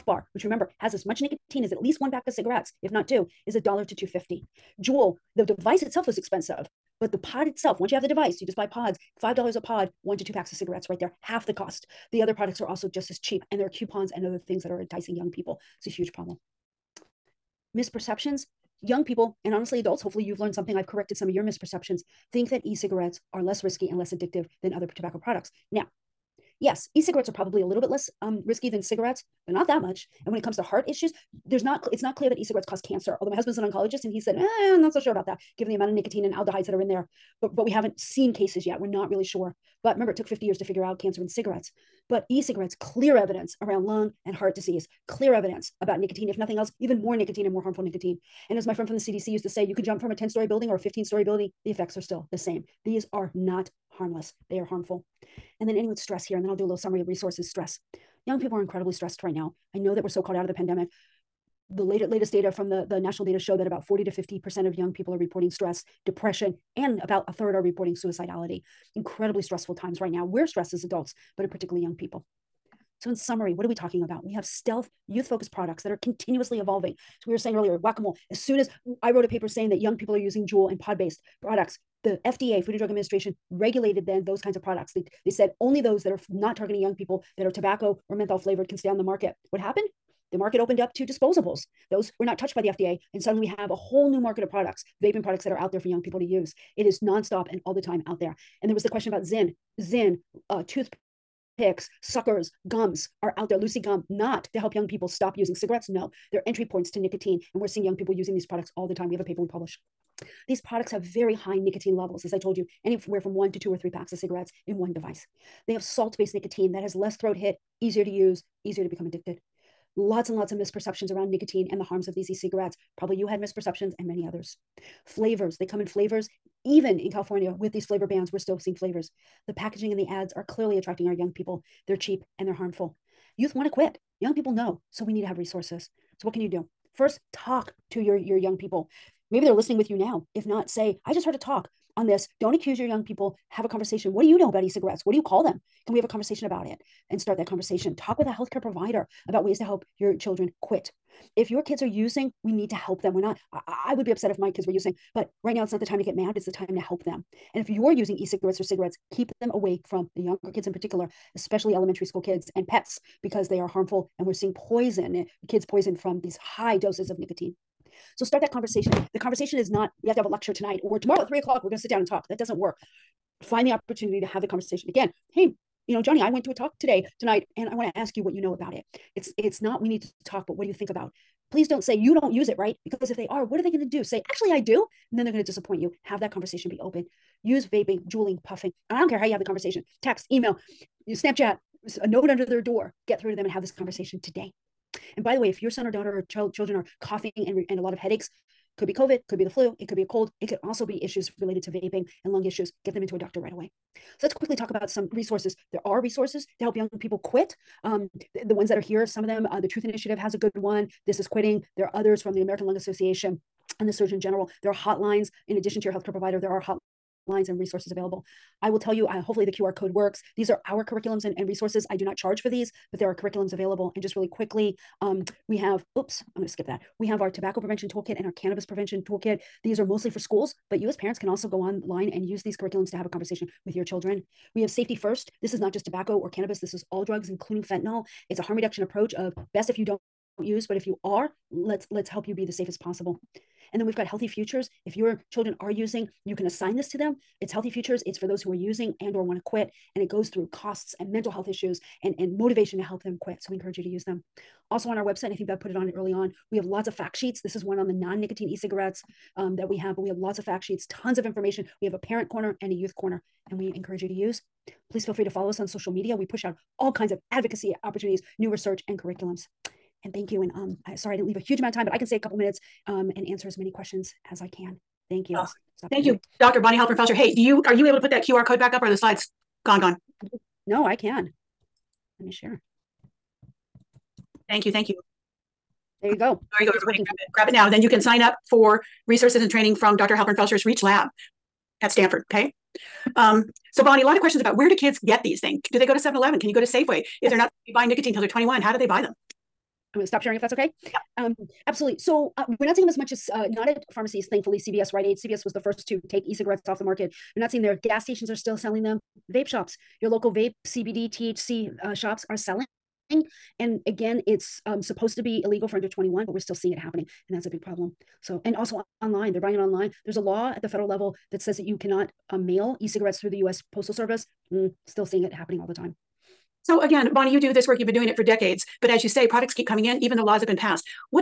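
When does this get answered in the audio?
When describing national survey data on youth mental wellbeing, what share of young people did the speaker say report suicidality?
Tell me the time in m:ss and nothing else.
1:07.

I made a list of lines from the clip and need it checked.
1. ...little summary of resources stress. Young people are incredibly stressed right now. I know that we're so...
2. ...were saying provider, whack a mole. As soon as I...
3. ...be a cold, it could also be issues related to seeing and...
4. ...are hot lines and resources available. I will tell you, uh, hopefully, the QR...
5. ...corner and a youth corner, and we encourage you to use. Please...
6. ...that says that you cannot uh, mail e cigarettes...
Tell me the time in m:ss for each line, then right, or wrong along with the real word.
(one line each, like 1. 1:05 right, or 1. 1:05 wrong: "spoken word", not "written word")
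1. 0:56 right
2. 1:17 wrong: "earlier", not "provider"
3. 3:19 wrong: "vaping", not "seeing"
4. 3:36 right
5. 4:22 right
6. 5:21 right.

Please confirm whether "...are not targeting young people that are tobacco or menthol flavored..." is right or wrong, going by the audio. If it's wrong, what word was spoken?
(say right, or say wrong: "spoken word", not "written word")
right.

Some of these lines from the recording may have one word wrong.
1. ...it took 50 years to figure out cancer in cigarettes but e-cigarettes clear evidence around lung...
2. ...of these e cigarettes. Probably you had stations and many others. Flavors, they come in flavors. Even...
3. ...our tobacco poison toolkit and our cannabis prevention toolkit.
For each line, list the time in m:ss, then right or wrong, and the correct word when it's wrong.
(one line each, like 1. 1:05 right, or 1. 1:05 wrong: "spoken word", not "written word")
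1. 0:40 right
2. 2:02 wrong: "misperceptions", not "stations"
3. 3:47 wrong: "prevention", not "poison".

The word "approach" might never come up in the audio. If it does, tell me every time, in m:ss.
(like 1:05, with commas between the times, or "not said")
3:58.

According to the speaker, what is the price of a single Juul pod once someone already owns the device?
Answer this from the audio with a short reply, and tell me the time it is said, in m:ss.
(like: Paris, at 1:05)
$5, at 0:09.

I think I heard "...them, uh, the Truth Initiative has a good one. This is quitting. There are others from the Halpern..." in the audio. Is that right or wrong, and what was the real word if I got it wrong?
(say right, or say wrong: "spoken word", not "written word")
wrong: "American", not "Halpern".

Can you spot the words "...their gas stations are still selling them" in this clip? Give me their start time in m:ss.
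5:07.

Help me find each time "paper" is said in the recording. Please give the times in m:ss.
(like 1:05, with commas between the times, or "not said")
1:19, 1:49.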